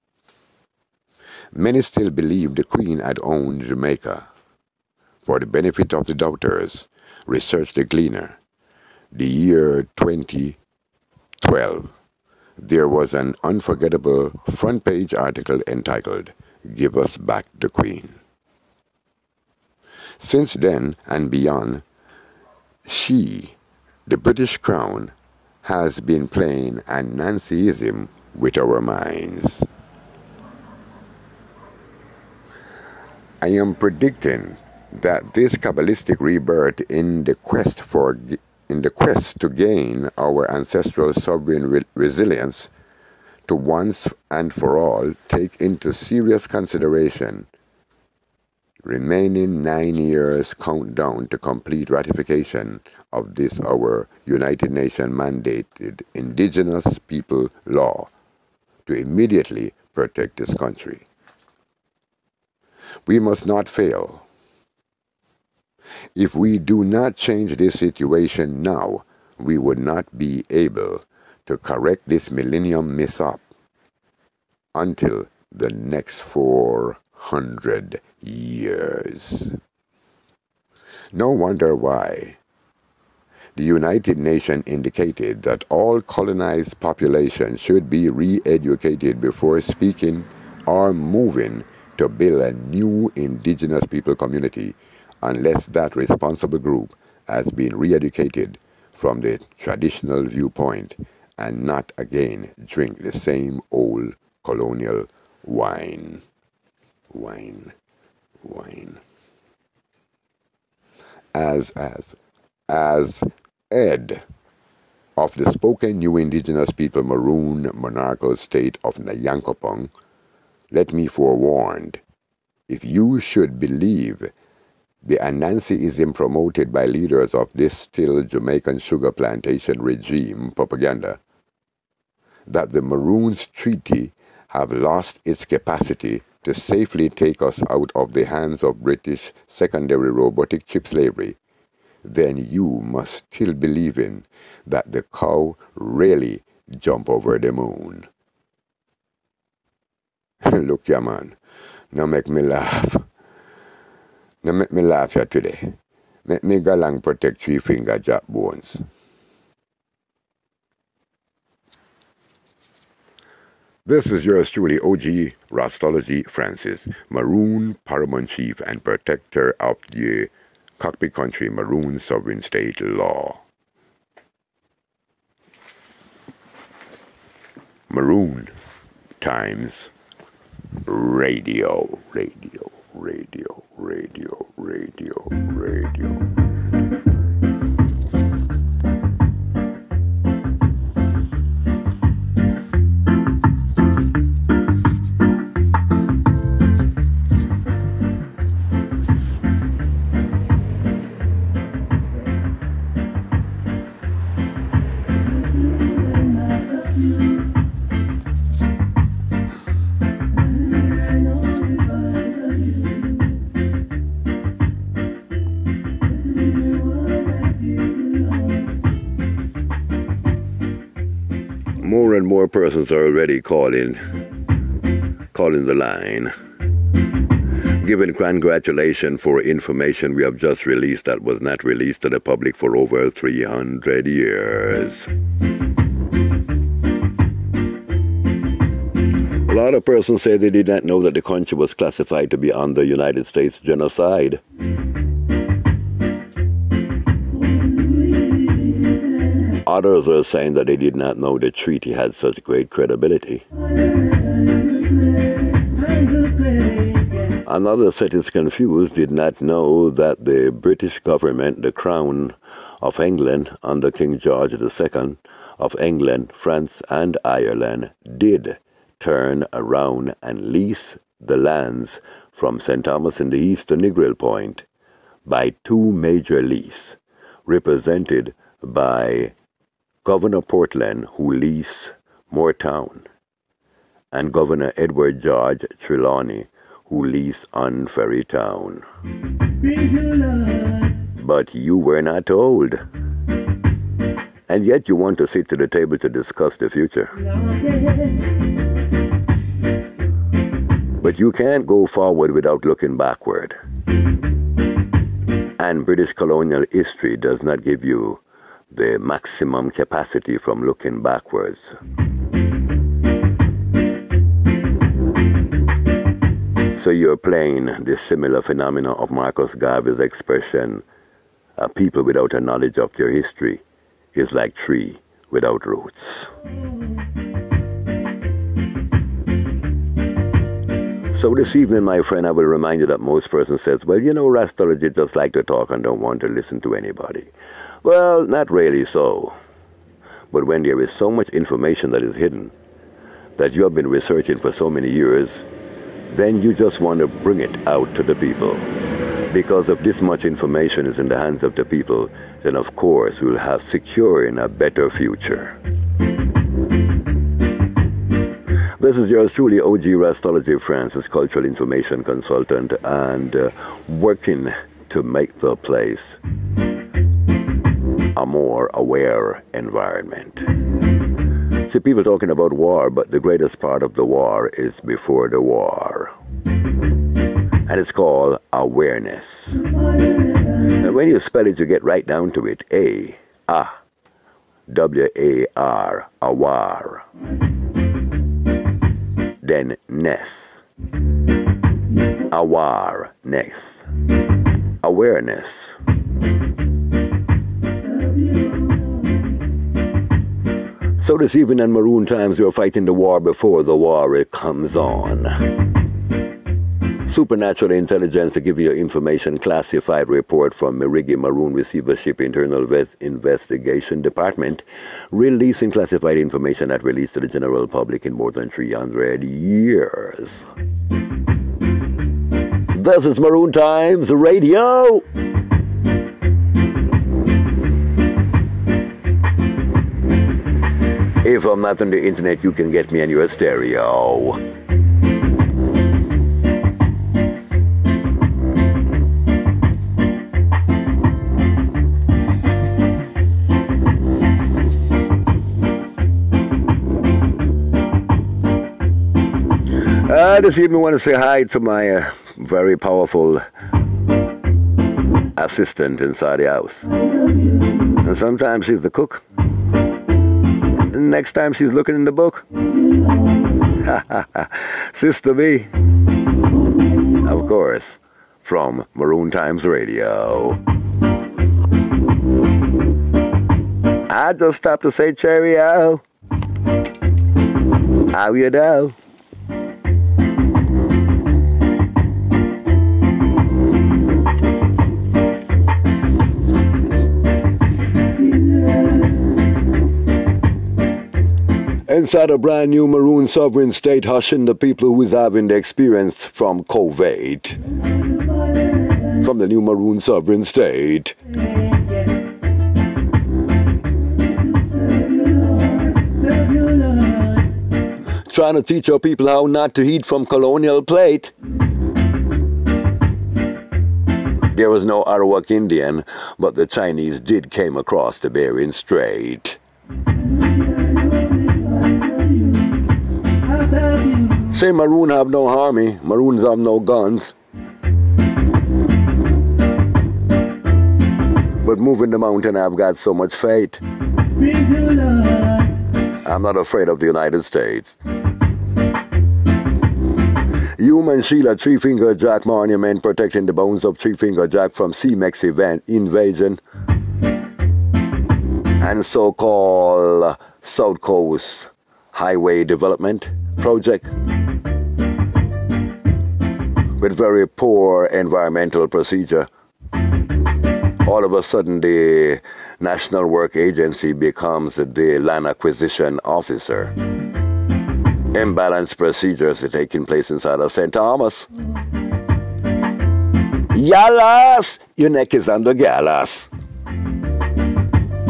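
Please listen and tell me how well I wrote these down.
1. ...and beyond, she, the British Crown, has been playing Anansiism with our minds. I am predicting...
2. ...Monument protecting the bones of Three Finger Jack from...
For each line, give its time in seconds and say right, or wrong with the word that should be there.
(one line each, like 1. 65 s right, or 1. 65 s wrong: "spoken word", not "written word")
1. 21 s right
2. 542 s right.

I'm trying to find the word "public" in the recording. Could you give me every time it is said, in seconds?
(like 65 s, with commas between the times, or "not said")
232 s, 417 s.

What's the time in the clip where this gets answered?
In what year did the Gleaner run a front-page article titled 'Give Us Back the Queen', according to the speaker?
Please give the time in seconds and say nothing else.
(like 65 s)
9 s.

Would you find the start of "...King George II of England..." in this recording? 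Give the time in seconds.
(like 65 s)
263 s.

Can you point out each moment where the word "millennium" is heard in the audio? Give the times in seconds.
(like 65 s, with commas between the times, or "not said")
72 s.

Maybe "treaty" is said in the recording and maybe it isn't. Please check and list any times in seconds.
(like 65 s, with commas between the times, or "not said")
133 s, 251 s.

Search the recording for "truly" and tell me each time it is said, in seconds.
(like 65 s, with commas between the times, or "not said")
164 s, 359 s.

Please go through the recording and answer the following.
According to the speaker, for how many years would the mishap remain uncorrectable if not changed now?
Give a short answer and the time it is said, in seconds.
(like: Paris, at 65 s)
400, at 76 s.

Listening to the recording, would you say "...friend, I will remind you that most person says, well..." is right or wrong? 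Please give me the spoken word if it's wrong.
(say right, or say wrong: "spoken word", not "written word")
right.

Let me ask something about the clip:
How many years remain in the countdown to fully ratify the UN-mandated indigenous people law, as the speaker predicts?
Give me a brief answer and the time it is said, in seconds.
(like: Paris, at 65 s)
9, at 49 s.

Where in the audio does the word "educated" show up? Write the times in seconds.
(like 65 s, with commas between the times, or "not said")
88 s, 97 s.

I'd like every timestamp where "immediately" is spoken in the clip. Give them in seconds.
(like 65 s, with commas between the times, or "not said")
58 s.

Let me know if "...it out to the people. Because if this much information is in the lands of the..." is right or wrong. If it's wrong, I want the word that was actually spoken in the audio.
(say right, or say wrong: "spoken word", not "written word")
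wrong: "hands", not "lands".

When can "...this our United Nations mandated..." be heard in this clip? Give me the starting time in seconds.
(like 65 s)
53 s.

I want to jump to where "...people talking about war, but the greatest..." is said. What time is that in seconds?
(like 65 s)
371 s.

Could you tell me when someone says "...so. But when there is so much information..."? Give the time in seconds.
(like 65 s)
338 s.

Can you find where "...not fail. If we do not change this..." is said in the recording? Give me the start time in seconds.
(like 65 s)
63 s.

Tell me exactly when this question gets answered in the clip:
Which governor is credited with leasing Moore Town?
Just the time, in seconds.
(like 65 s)
280 s.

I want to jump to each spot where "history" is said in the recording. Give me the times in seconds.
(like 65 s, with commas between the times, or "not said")
306 s, 323 s.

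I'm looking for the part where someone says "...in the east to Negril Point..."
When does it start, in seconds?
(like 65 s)
273 s.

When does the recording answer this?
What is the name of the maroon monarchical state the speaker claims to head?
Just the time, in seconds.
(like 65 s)
118 s.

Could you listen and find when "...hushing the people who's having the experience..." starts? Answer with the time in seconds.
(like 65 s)
494 s.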